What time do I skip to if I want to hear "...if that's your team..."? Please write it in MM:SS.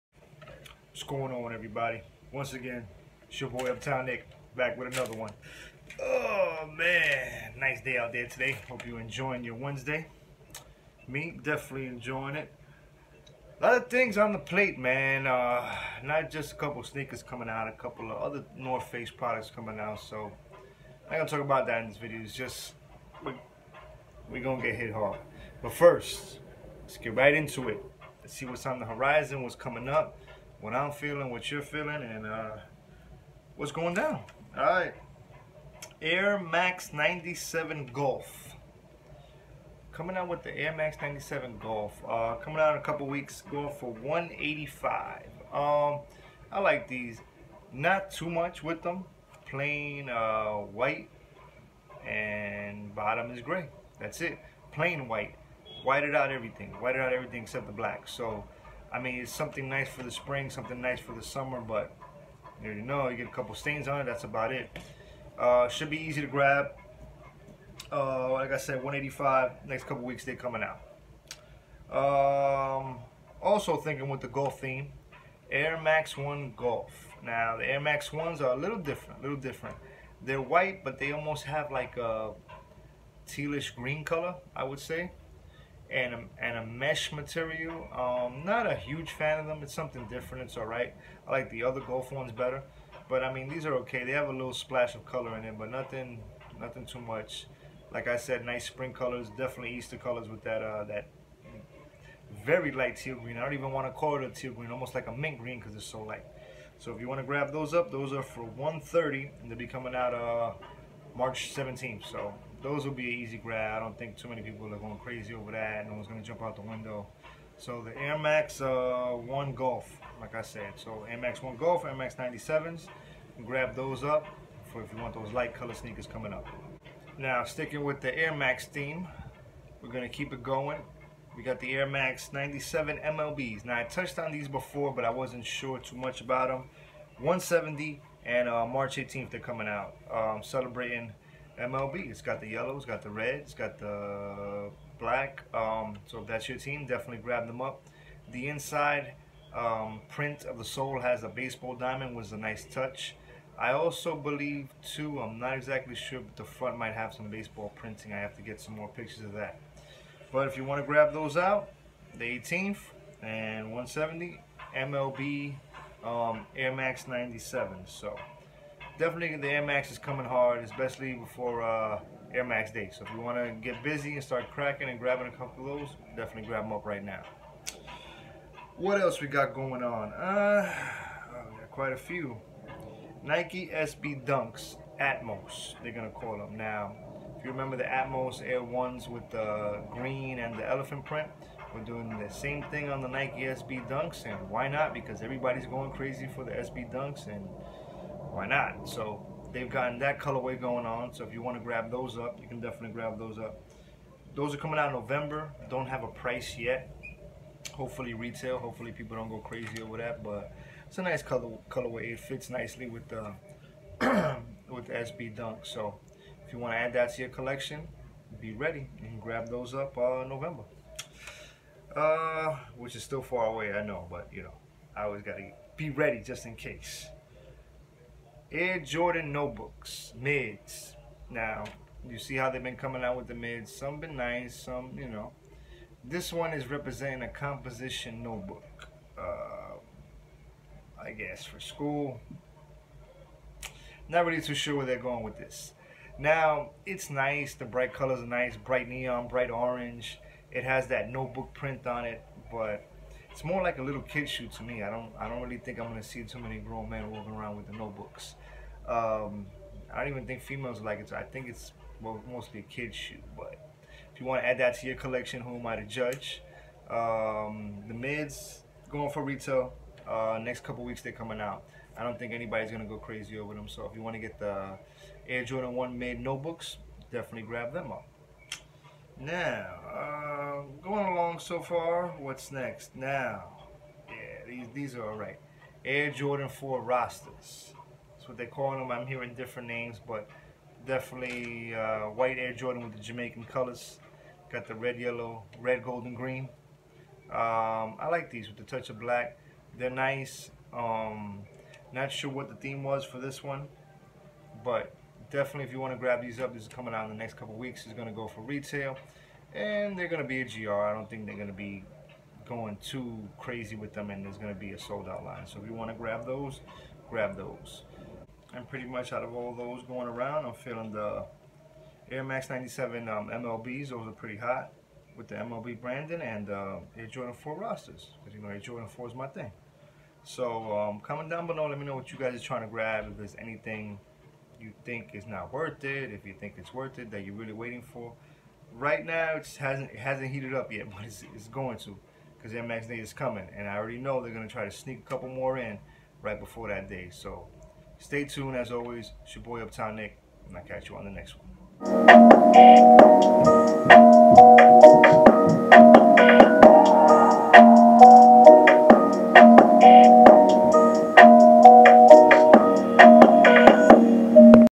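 02:26.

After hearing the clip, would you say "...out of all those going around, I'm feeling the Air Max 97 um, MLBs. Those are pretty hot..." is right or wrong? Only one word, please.
right.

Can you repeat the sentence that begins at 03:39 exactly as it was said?
and grab those up uh, November.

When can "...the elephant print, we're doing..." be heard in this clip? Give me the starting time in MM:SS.
03:10.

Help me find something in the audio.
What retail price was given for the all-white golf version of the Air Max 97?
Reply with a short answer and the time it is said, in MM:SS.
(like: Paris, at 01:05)
185, at 00:43.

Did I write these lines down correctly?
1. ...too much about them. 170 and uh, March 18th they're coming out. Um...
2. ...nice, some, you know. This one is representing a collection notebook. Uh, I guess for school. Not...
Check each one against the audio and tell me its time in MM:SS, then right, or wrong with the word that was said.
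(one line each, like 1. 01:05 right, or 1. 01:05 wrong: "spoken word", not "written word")
1. 02:15 right
2. 03:54 wrong: "composition", not "collection".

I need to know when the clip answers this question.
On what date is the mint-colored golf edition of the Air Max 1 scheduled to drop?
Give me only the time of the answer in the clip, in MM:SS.
01:51.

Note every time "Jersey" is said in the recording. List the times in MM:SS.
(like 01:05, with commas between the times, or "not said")
not said.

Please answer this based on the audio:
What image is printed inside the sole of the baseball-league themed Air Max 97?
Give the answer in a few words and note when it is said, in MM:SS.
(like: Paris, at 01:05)
baseball diamond, at 02:31.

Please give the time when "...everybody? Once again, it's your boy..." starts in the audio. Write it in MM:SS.
00:01.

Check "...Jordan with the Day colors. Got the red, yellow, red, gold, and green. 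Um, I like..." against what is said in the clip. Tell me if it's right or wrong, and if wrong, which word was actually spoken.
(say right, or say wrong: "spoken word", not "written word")
wrong: "Jamaican", not "Day".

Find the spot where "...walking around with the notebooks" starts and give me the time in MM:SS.
04:17.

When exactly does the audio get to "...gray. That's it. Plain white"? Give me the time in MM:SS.
00:53.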